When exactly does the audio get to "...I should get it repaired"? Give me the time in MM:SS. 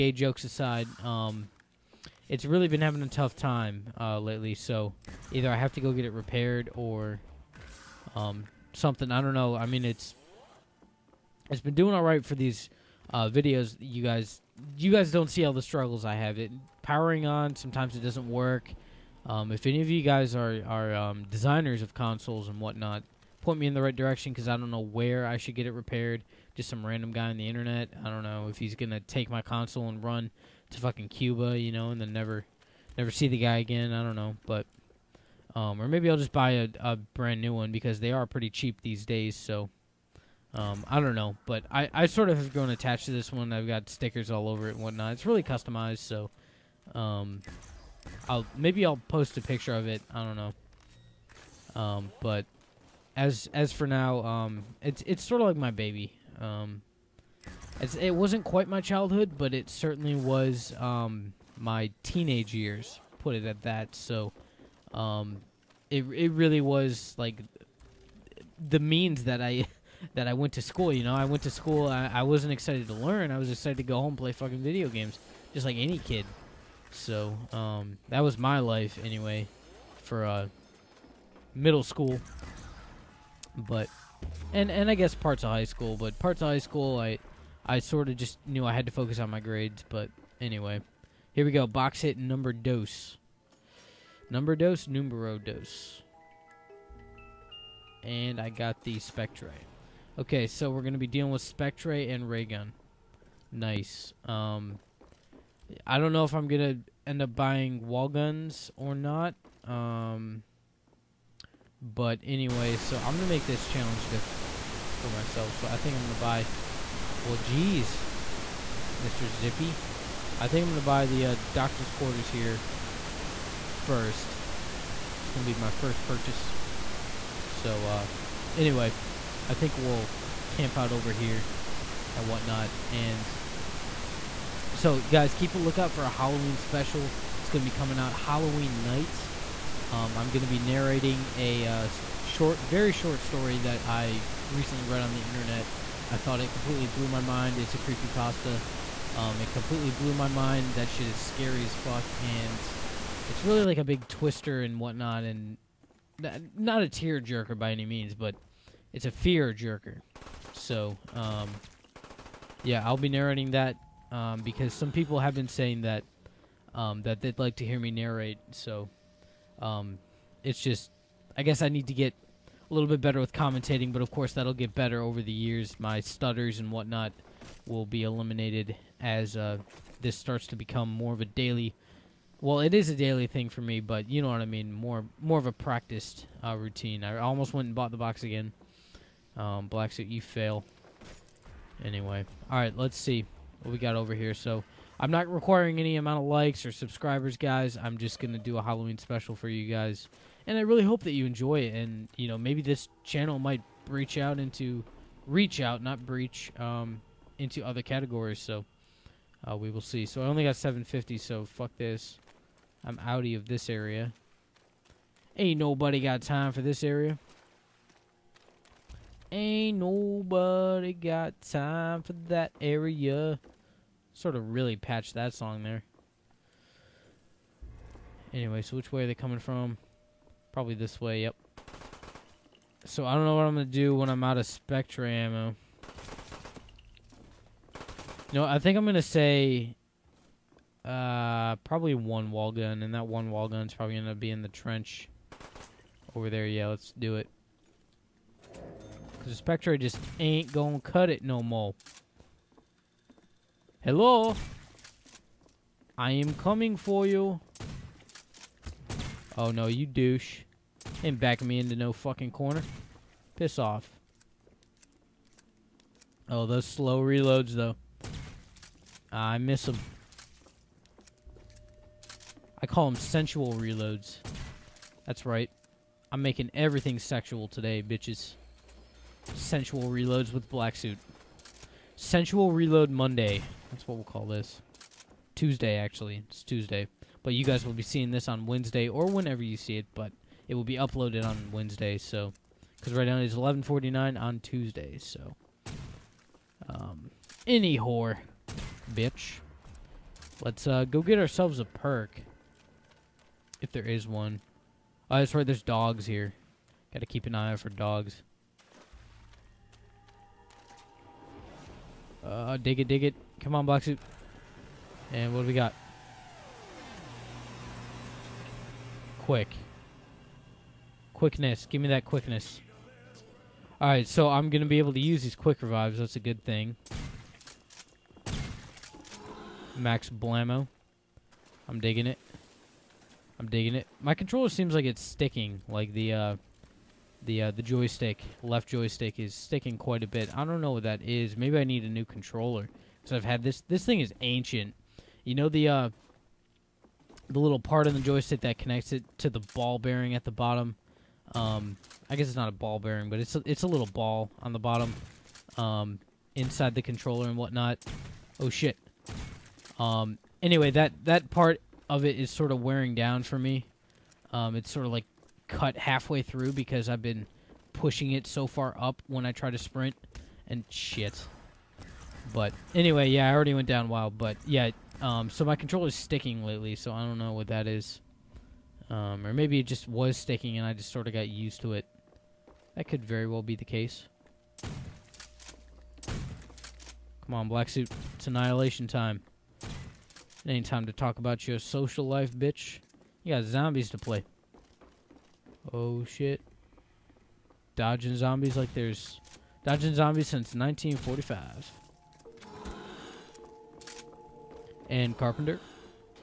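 00:25.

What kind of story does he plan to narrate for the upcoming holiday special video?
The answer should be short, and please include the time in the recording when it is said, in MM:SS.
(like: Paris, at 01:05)
creepy pasta, at 02:27.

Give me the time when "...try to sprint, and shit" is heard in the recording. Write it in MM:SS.
06:09.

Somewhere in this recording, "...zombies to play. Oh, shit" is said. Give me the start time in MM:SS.
06:33.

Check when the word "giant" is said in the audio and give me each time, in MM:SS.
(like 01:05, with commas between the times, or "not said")
not said.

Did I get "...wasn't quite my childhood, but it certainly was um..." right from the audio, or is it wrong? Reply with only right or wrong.
right.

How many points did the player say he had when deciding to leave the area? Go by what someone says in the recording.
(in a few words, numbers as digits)
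750.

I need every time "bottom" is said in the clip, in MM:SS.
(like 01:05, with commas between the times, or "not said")
05:50, 05:54.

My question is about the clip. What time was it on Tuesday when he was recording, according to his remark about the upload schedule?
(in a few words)
11:49.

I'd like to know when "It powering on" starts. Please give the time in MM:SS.
00:16.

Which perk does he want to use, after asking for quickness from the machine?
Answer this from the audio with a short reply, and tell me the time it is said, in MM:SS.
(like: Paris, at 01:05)
quick revives, at 05:25.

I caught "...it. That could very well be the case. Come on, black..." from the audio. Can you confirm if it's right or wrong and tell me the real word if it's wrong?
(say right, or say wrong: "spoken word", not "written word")
right.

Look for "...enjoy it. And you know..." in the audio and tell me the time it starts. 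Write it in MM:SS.
03:21.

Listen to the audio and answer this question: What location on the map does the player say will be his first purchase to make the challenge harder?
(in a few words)
doctor's quarters.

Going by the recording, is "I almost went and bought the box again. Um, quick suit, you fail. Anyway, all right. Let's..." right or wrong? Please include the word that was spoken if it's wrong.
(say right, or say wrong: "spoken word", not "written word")
wrong: "black", not "quick".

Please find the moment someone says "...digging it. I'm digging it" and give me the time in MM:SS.
05:31.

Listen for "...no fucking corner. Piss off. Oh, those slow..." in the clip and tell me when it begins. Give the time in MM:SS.
04:21.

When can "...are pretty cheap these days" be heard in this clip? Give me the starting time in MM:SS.
00:38.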